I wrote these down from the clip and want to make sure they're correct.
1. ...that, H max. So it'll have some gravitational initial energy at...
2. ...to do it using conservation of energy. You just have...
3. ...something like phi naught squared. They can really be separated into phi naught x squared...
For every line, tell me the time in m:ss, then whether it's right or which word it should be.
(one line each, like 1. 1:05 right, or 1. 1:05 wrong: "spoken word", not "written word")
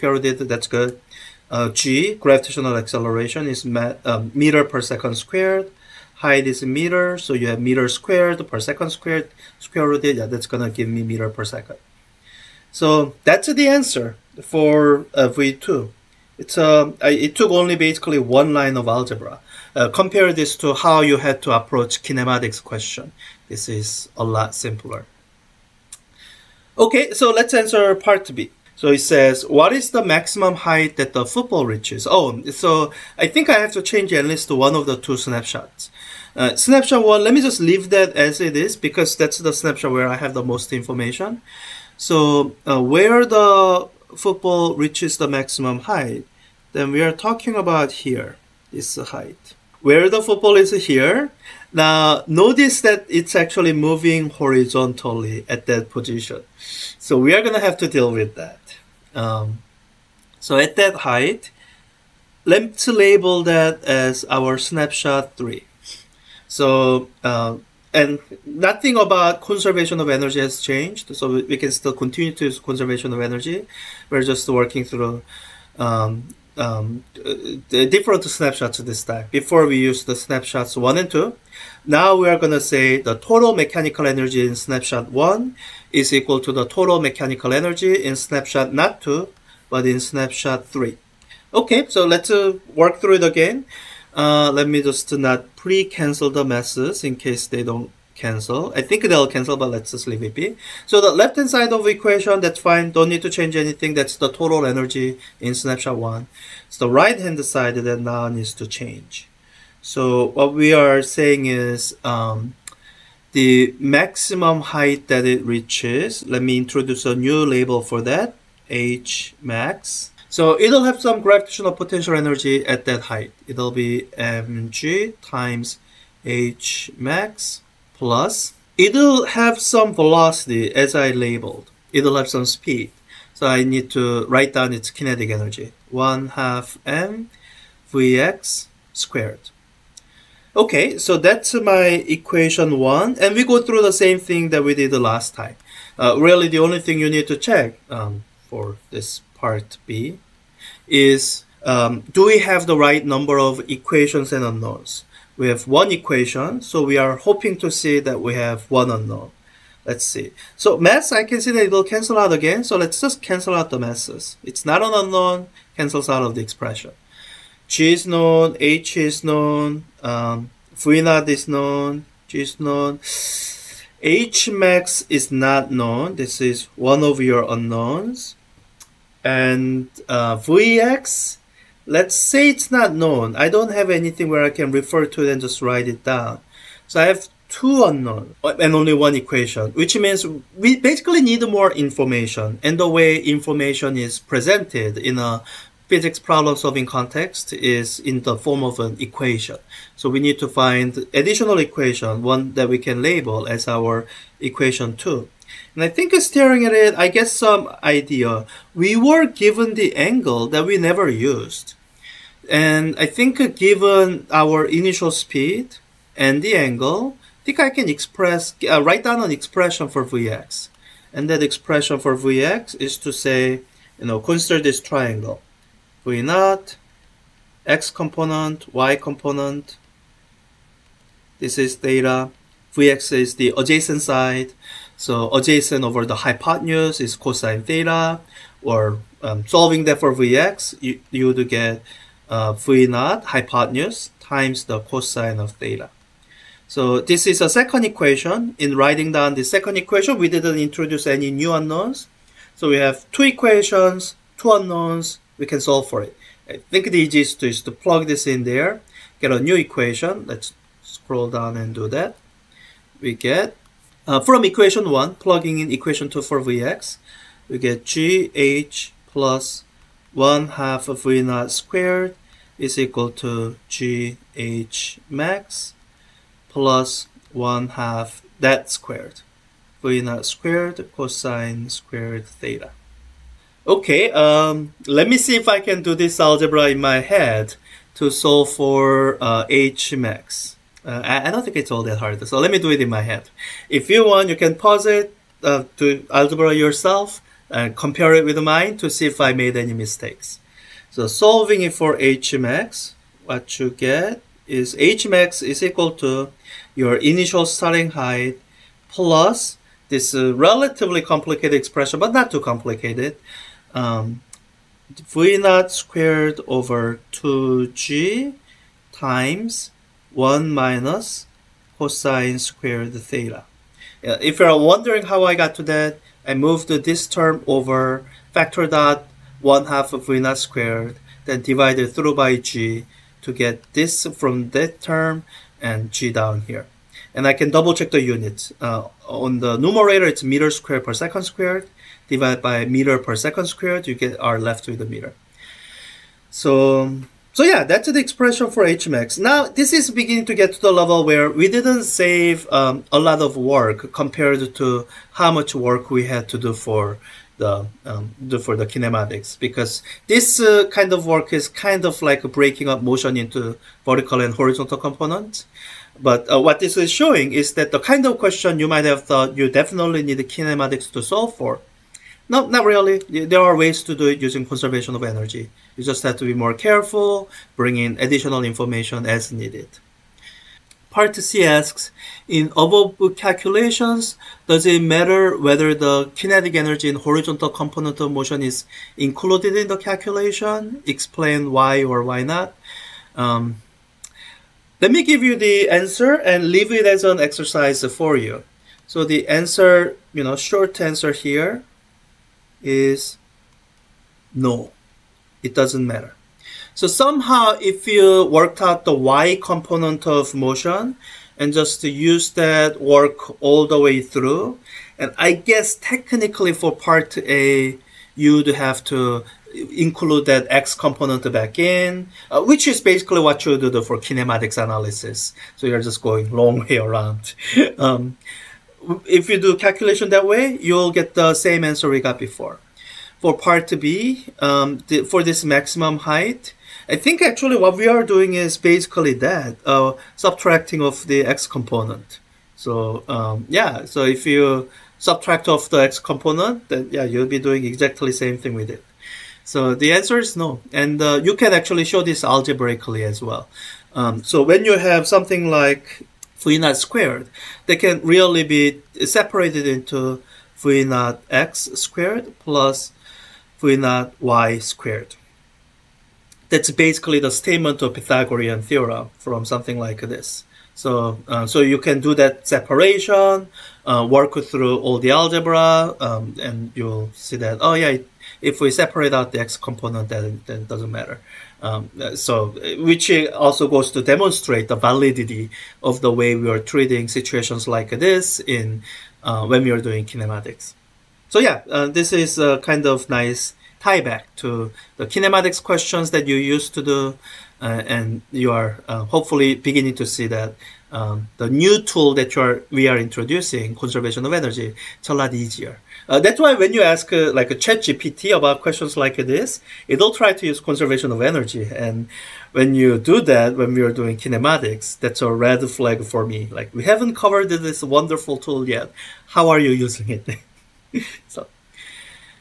1. 1:58 wrong: "potential", not "initial"
2. 6:13 right
3. 7:35 right.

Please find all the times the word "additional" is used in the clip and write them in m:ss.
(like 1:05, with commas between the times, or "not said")
3:21, 6:17.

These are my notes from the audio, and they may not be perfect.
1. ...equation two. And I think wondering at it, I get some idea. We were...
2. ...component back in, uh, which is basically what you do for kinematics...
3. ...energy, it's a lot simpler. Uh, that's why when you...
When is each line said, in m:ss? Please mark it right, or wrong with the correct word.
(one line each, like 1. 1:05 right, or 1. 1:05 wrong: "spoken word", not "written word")
1. 3:24 wrong: "staring", not "wondering"
2. 7:00 right
3. 8:24 wrong: "easier", not "simpler".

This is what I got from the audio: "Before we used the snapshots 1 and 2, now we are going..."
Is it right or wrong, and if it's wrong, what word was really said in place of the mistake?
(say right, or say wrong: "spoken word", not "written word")
right.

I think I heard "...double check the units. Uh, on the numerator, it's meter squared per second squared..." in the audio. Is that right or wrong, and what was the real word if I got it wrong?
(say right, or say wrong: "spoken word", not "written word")
right.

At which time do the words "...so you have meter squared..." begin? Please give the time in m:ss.
0:07.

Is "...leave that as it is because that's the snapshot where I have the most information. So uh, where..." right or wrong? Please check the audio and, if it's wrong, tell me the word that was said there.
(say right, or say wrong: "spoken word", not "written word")
right.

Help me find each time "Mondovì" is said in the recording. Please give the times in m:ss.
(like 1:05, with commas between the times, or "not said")
not said.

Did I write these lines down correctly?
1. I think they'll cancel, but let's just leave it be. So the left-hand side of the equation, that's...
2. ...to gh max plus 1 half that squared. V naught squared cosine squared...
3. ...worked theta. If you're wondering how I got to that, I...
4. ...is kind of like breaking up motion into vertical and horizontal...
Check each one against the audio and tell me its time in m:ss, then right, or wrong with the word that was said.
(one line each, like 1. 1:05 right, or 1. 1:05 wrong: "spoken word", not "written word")
1. 1:38 right
2. 4:33 right
3. 5:22 wrong: "squared", not "worked"
4. 6:01 right.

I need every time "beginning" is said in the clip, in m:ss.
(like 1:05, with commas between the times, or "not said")
5:49, 8:19.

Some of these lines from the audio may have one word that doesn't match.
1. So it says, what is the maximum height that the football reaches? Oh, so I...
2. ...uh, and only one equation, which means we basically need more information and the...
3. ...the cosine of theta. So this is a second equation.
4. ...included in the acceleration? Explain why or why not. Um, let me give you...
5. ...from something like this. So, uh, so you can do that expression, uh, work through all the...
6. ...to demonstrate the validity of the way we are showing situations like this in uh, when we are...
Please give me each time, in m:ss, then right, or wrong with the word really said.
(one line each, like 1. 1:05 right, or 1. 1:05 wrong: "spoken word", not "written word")
1. 0:28 right
2. 3:08 right
3. 4:04 right
4. 6:28 wrong: "calculation", not "acceleration"
5. 7:49 wrong: "separation", not "expression"
6. 8:03 wrong: "treating", not "showing".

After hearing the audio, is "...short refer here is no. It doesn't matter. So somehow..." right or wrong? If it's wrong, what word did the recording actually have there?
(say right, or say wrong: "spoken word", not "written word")
wrong: "answer", not "refer".